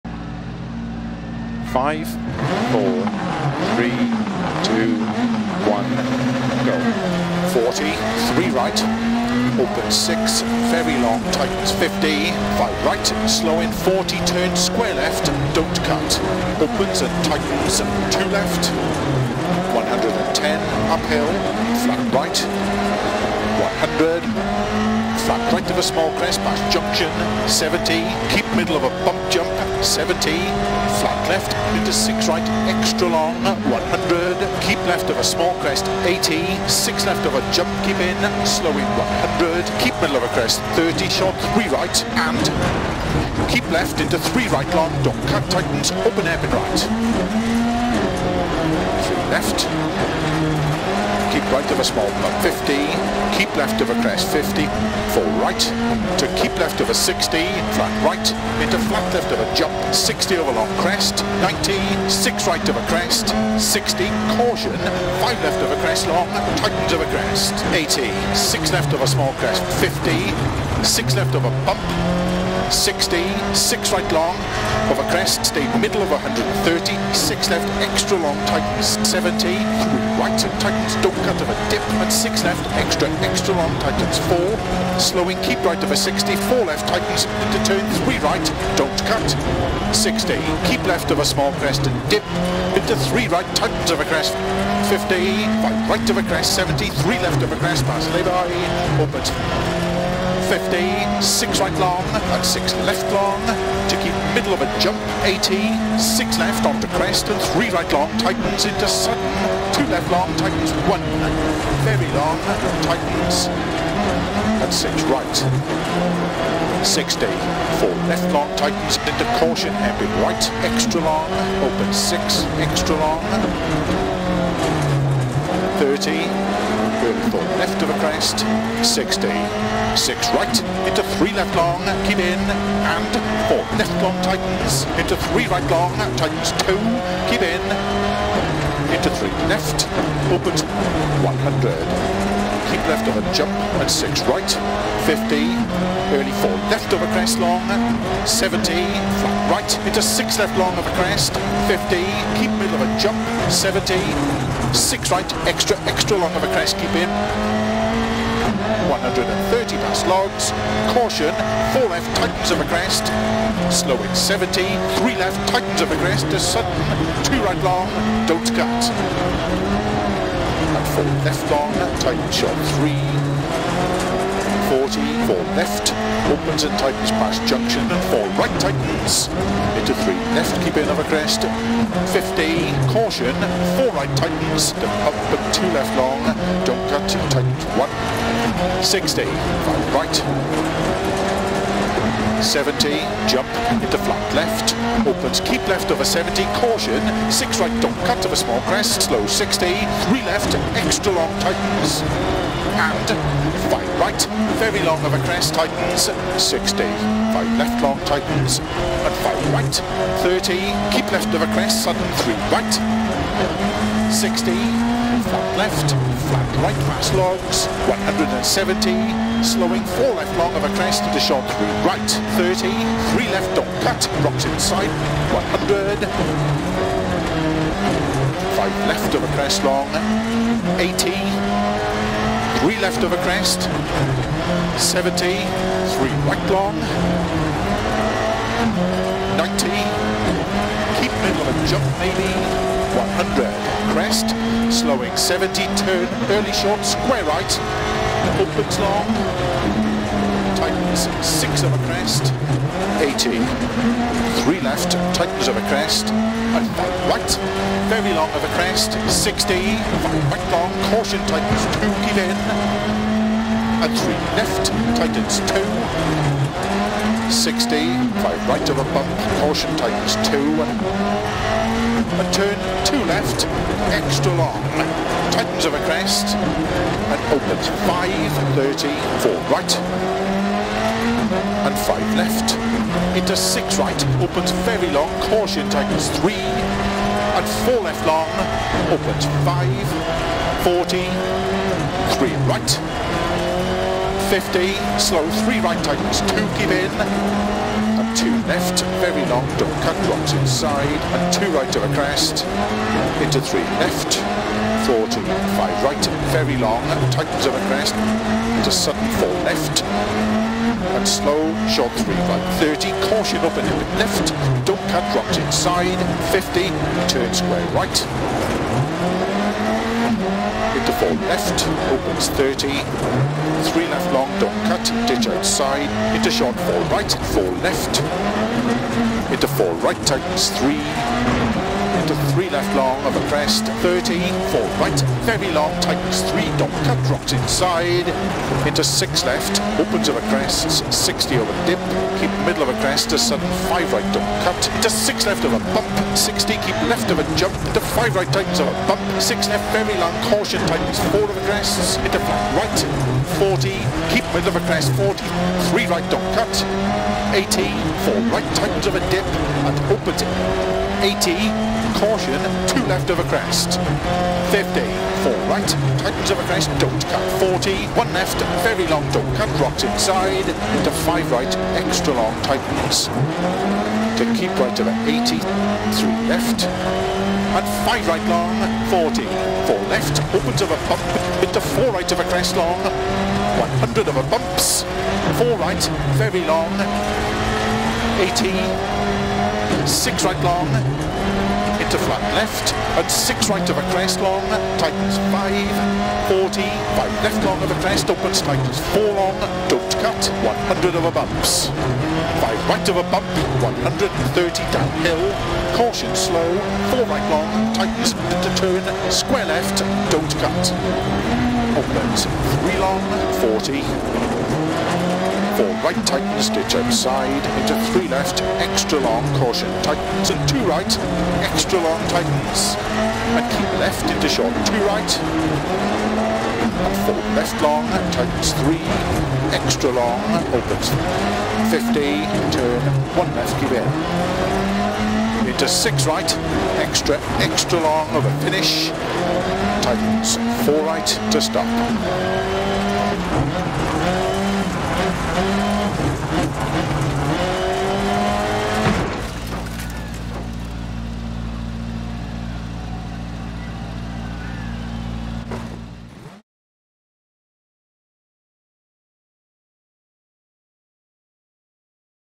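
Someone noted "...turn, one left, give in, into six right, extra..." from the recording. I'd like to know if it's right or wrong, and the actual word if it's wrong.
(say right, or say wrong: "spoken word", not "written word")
right.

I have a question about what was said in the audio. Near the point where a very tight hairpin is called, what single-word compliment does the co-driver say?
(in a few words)
beautiful.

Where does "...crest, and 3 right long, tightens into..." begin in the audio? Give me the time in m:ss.
1:46.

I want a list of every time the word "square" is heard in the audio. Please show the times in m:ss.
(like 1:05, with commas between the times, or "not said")
0:14, 4:06, 5:17, 6:49.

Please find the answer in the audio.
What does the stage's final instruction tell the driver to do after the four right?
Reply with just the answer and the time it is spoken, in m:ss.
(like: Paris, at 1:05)
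stop, at 7:21.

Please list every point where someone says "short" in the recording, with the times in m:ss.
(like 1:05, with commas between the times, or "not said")
0:41, 3:41, 4:06, 5:11, 5:26, 7:04.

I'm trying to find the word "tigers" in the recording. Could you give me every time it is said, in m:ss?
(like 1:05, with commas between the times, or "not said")
4:45, 4:55.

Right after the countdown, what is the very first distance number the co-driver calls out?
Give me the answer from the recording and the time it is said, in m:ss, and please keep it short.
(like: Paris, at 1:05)
40, at 0:07.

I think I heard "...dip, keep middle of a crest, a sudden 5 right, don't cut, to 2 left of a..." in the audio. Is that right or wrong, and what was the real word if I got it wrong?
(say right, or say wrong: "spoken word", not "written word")
wrong: "6", not "2".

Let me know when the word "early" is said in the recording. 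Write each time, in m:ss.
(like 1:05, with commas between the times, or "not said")
2:26, 4:06.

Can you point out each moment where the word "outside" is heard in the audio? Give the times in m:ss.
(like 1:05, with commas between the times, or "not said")
5:25, 6:56.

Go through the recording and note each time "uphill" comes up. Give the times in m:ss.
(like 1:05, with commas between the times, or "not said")
0:20.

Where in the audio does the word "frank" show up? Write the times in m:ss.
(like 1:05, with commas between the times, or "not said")
not said.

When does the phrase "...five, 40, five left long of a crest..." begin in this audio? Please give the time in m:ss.
6:35.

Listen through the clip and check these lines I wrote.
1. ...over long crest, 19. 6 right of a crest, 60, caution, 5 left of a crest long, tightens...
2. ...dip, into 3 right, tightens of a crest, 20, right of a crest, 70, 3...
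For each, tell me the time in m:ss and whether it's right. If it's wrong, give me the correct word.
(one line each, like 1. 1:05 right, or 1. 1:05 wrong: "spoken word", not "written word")
1. 1:00 right
2. 1:32 wrong: "50", not "20".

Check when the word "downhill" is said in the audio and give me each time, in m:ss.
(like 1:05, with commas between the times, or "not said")
6:44.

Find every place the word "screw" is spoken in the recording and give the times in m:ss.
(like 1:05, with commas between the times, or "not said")
not said.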